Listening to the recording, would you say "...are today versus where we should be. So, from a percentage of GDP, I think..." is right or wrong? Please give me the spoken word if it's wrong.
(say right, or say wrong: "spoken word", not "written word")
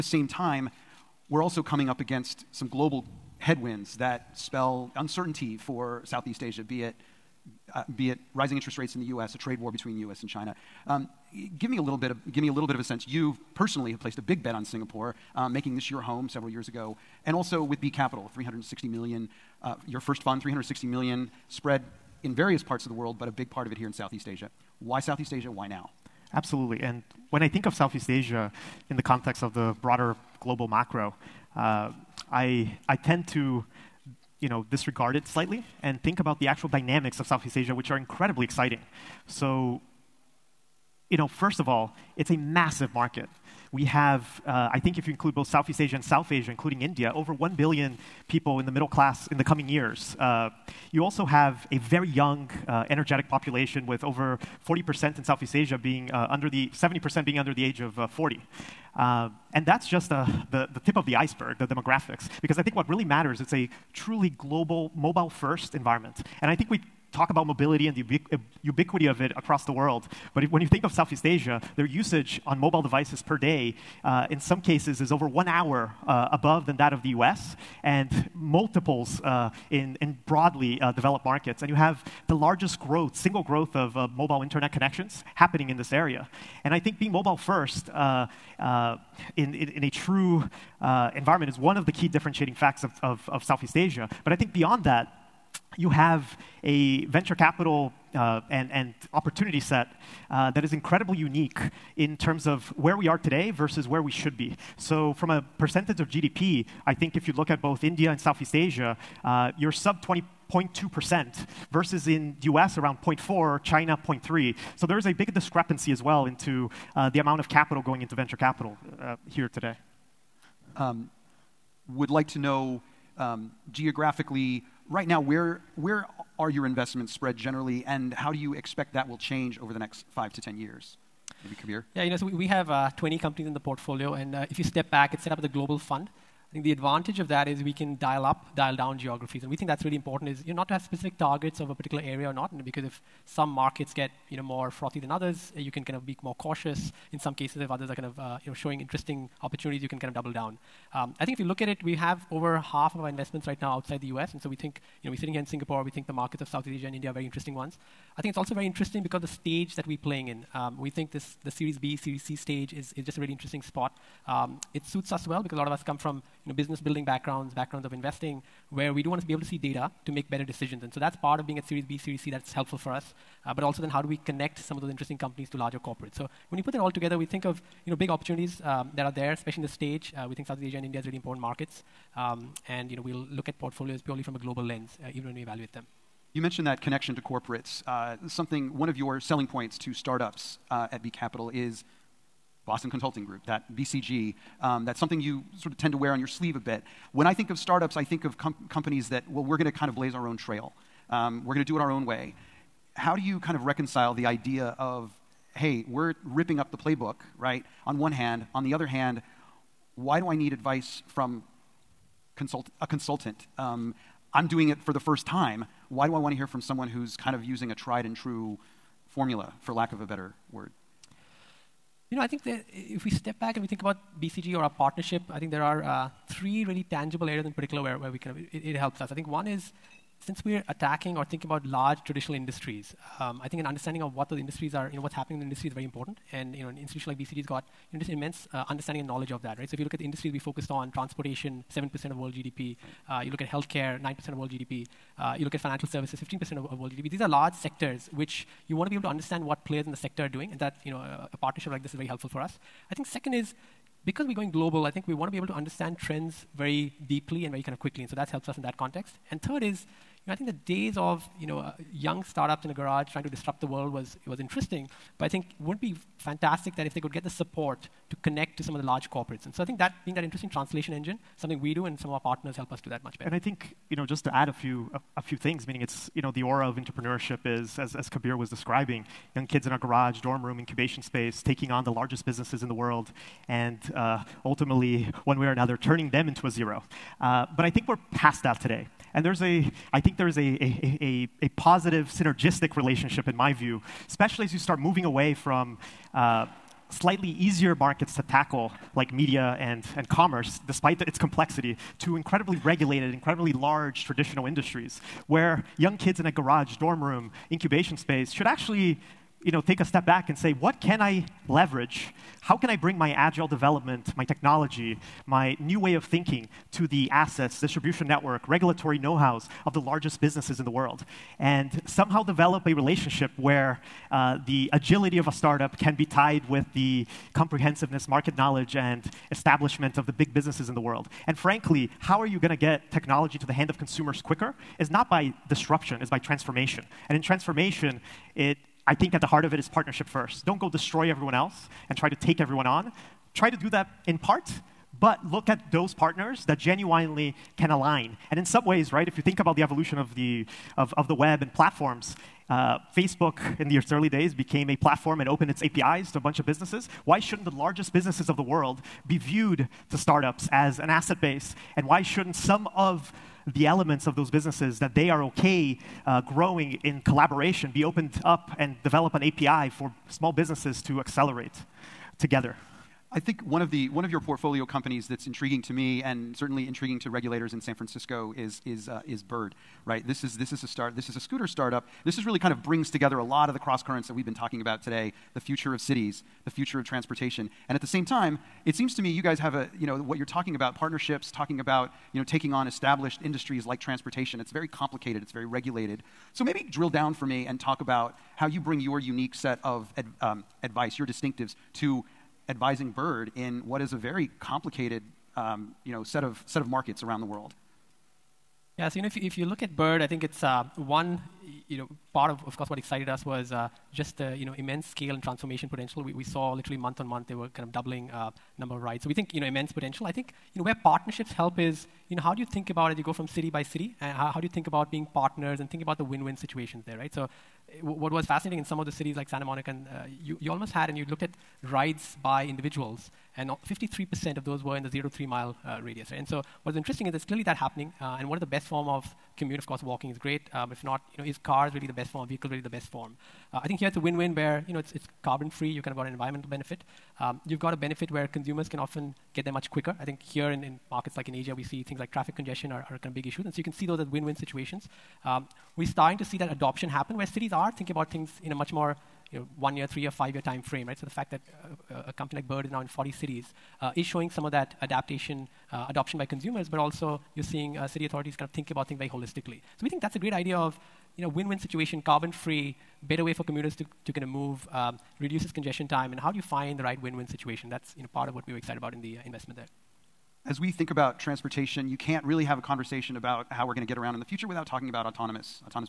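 right.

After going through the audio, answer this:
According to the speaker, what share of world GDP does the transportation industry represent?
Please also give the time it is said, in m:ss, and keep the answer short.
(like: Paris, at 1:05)
7%, at 4:01.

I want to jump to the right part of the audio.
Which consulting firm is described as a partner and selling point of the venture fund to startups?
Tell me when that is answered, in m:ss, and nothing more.
3:12.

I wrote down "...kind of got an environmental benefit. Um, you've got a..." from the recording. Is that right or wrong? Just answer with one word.
right.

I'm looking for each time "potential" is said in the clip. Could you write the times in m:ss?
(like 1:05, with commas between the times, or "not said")
6:55, 6:59.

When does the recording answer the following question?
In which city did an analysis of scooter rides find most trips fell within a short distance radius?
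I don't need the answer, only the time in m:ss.
7:09.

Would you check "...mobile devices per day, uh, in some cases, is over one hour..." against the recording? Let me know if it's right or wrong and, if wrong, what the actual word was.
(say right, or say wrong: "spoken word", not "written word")
right.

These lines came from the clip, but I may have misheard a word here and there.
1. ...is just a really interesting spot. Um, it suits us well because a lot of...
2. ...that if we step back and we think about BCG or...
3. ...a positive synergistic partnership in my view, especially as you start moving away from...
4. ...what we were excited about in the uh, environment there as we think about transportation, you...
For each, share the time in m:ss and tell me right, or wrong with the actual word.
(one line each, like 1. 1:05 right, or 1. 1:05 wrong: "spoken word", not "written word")
1. 2:42 right
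2. 3:42 right
3. 4:51 wrong: "relationship", not "partnership"
4. 7:58 wrong: "investment", not "environment".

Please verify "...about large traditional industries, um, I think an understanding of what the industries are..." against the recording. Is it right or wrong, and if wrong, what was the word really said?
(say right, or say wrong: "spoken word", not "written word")
right.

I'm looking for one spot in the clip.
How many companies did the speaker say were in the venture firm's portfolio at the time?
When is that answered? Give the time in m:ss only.
2:12.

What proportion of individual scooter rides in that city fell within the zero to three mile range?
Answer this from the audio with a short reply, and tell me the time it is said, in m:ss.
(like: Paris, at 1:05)
53%, at 7:13.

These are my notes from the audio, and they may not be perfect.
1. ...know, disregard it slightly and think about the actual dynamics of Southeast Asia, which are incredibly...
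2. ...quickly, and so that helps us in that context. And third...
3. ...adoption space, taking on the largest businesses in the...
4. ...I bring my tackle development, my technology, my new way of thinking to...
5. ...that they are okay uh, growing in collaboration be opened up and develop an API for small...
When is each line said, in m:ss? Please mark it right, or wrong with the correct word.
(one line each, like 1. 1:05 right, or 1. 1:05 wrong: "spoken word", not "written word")
1. 0:34 right
2. 4:17 right
3. 4:40 wrong: "incubation", not "adoption"
4. 5:12 wrong: "agile", not "tackle"
5. 6:04 right.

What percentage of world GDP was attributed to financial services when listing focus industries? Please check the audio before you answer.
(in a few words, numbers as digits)
15%.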